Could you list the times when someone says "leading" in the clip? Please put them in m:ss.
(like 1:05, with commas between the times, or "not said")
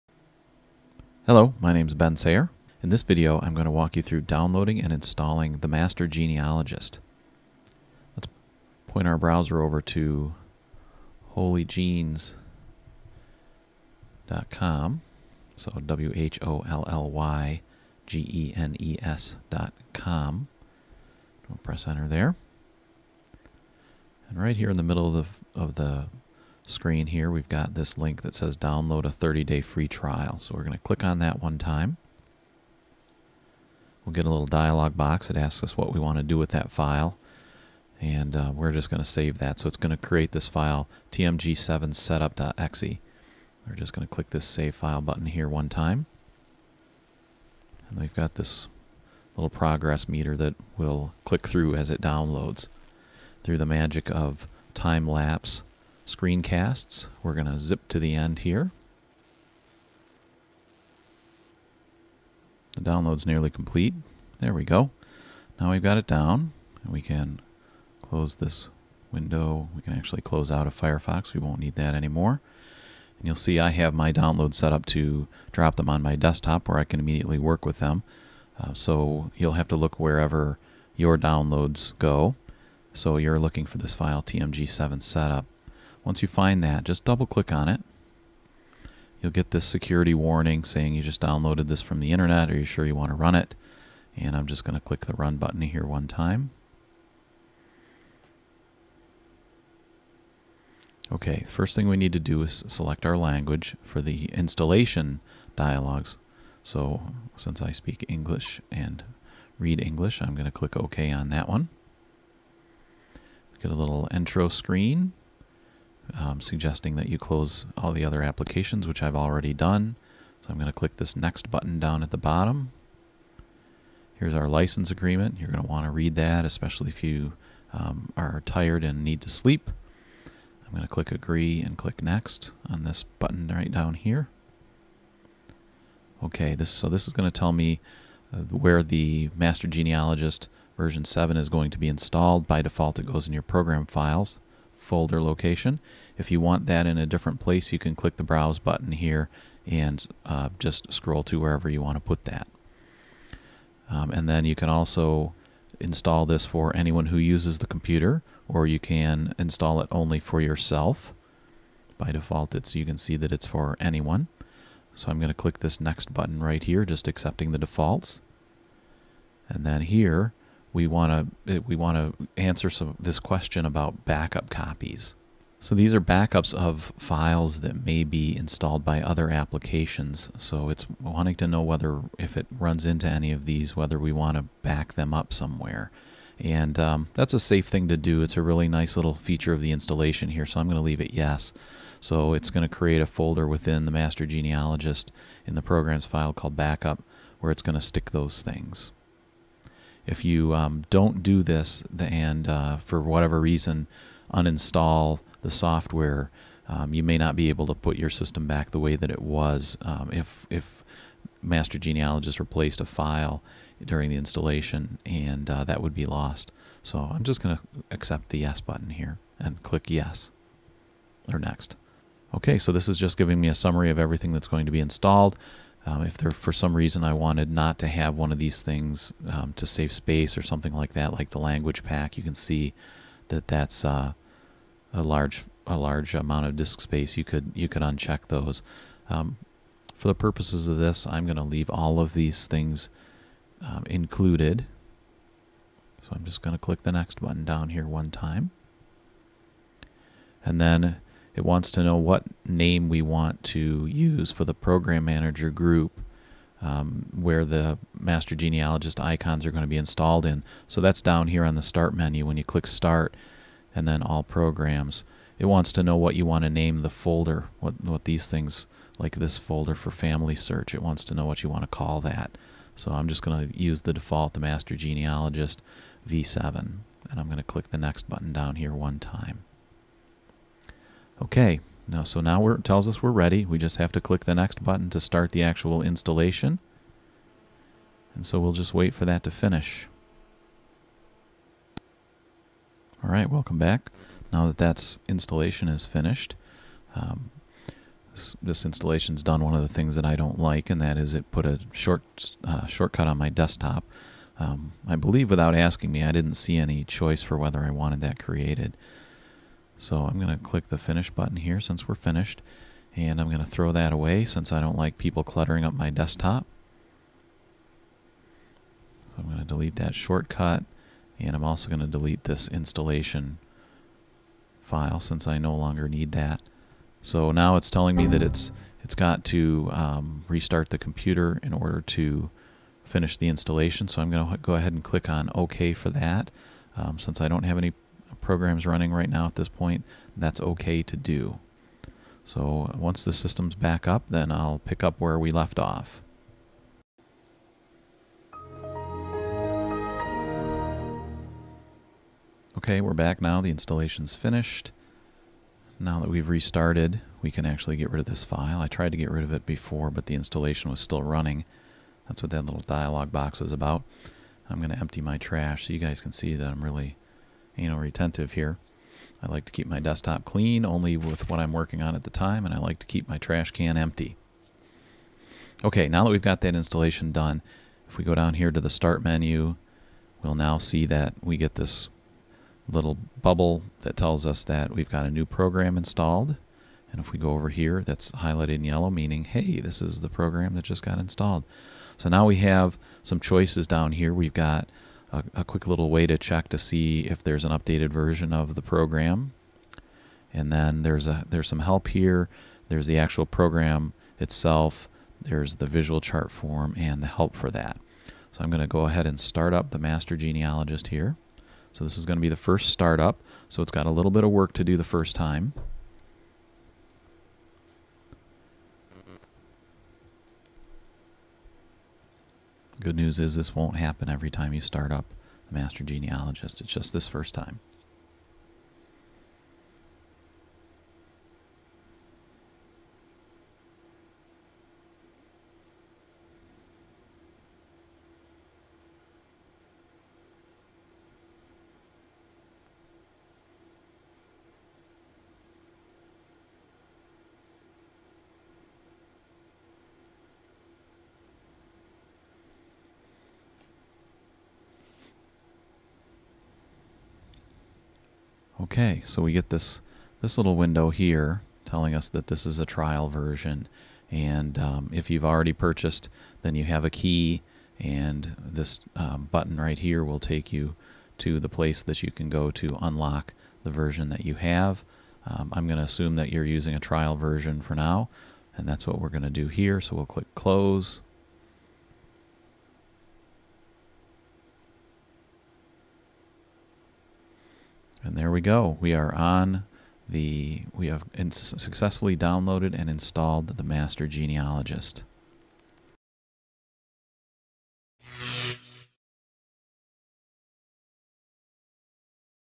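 not said.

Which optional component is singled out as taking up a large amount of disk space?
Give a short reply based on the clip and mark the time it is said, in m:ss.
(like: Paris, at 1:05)
language pack, at 3:51.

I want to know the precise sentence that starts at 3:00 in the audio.
So it's wanting to know whether if it runs into any of these, whether we want to back them up somewhere.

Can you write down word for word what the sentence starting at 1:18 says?
Uh, so you'll have to look wherever your downloads go.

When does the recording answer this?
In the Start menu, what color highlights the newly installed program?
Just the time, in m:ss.
6:28.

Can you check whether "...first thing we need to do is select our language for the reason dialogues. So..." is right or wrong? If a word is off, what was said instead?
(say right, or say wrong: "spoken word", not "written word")
wrong: "installation", not "reason".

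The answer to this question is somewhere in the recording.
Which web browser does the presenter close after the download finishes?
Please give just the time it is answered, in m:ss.
1:10.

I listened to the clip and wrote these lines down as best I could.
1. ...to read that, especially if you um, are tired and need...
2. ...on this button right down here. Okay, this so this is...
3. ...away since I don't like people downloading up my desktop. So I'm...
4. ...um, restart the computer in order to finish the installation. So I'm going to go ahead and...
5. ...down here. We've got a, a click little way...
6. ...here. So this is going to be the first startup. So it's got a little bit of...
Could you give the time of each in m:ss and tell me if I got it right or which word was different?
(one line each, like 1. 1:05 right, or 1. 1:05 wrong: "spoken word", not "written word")
1. 2:05 right
2. 2:12 right
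3. 5:13 wrong: "cluttering", not "downloading"
4. 5:29 right
5. 6:33 wrong: "quick", not "click"
6. 6:50 right.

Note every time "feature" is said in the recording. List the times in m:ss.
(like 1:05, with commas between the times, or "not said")
3:09.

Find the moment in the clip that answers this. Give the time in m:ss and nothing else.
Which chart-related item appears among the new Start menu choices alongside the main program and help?
6:45.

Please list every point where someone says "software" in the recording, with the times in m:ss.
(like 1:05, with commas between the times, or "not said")
3:25.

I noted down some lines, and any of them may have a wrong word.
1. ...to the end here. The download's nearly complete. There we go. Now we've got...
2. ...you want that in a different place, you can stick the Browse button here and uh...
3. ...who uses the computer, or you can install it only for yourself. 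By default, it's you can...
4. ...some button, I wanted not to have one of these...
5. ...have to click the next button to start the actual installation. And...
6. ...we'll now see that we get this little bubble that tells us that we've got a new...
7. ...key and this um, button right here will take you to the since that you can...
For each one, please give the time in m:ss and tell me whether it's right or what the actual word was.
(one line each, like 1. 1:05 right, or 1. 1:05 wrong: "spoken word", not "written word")
1. 0:57 right
2. 2:26 wrong: "click", not "stick"
3. 2:37 right
4. 3:46 wrong: "reason", not "button"
5. 4:43 right
6. 6:20 right
7. 7:46 wrong: "place", not "since".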